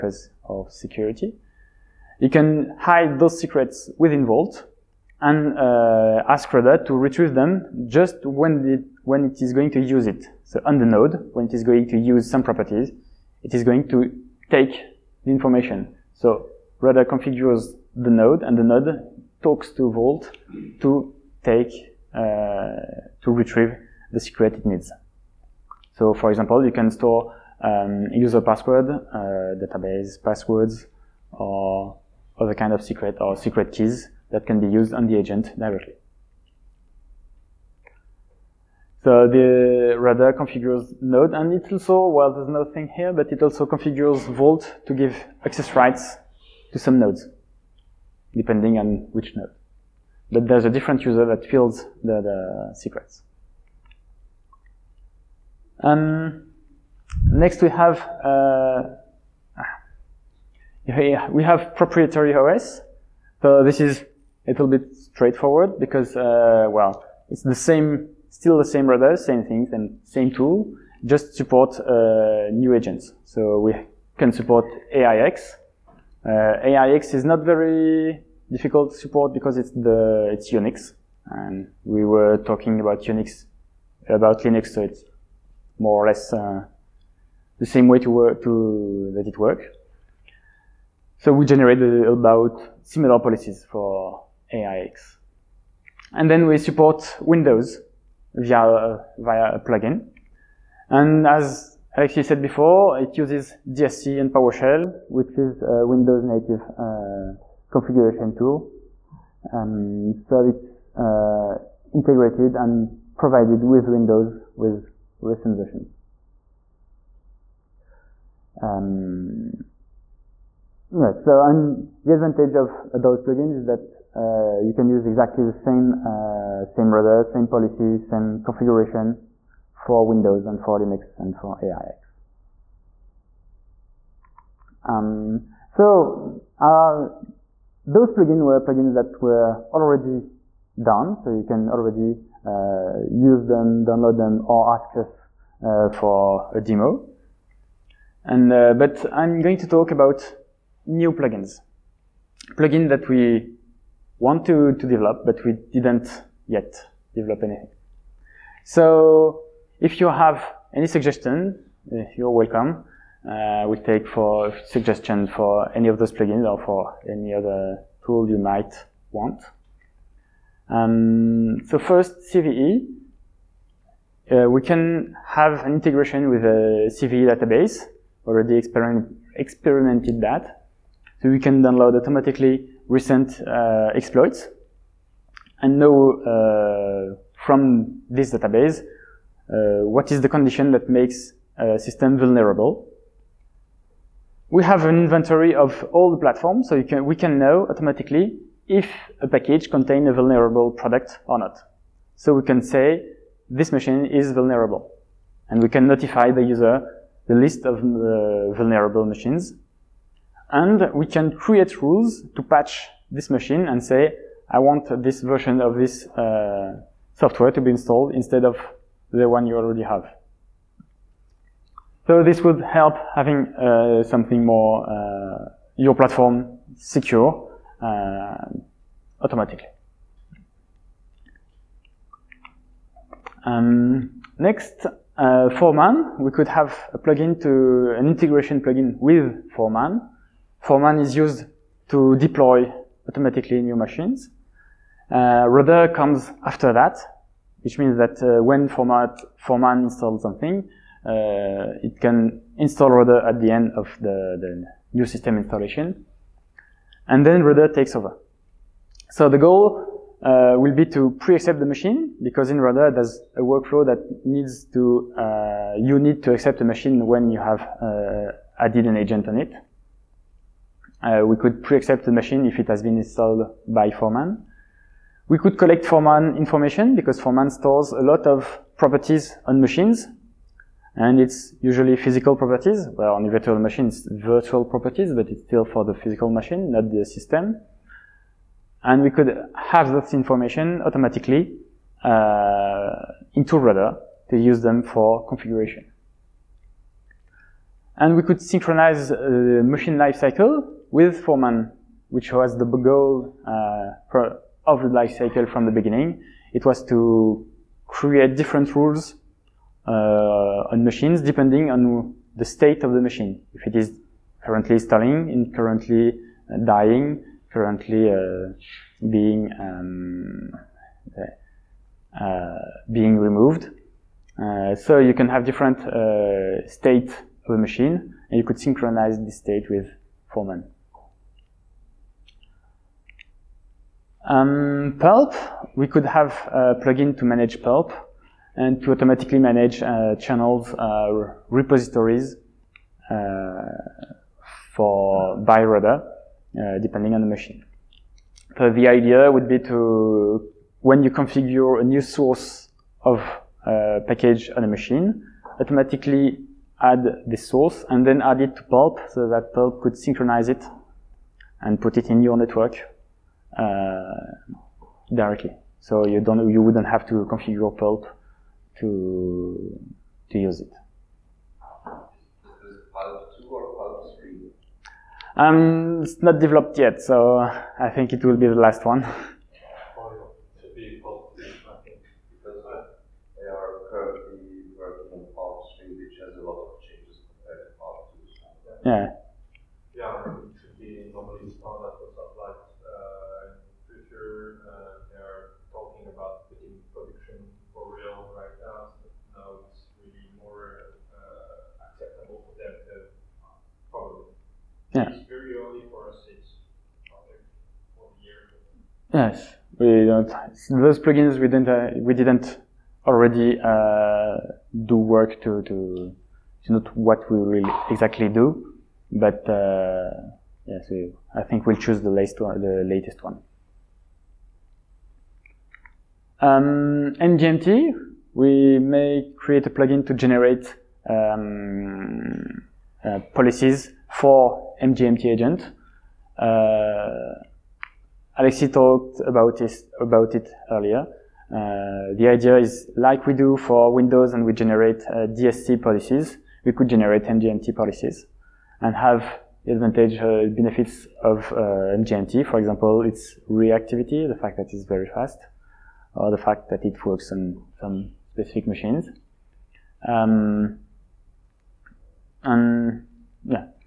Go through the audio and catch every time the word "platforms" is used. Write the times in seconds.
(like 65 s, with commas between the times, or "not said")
196 s, 225 s.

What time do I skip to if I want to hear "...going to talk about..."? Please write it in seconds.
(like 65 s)
149 s.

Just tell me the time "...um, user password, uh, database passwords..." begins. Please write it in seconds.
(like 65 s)
27 s.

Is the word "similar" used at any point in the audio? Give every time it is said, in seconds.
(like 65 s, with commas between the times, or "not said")
92 s.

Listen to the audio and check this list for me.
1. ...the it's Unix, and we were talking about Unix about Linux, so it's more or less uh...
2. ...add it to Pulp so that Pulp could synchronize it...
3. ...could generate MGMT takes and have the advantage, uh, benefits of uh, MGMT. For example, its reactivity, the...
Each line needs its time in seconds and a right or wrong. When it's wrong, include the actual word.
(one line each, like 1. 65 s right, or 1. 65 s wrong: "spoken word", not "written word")
1. 79 s right
2. 358 s right
3. 446 s wrong: "policies", not "takes".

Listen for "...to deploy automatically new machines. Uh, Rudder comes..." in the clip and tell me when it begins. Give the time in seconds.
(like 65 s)
241 s.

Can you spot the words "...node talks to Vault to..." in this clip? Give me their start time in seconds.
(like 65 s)
18 s.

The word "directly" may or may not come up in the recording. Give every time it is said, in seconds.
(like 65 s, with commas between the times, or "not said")
35 s, 365 s.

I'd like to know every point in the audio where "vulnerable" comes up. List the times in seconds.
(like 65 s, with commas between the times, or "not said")
192 s, 200 s, 204 s, 208 s.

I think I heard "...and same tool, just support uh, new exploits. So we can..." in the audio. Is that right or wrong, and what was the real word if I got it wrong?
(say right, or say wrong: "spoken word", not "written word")
wrong: "agents", not "exploits".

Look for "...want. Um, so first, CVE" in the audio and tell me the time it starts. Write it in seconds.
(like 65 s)
169 s.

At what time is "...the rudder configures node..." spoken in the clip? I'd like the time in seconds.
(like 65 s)
39 s.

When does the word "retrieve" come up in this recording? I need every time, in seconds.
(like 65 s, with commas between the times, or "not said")
6 s, 23 s.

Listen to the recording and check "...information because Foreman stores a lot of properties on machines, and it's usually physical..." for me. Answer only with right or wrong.
right.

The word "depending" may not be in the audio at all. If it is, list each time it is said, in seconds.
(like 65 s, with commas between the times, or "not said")
48 s, 311 s, 346 s.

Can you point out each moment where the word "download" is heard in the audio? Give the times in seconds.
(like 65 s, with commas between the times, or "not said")
143 s, 181 s.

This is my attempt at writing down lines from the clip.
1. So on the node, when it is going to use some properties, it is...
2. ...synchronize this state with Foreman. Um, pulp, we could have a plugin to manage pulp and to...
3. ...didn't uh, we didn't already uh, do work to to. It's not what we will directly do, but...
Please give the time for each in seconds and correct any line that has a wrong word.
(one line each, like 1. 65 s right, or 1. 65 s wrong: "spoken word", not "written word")
1. 10 s right
2. 328 s right
3. 411 s wrong: "exactly", not "directly".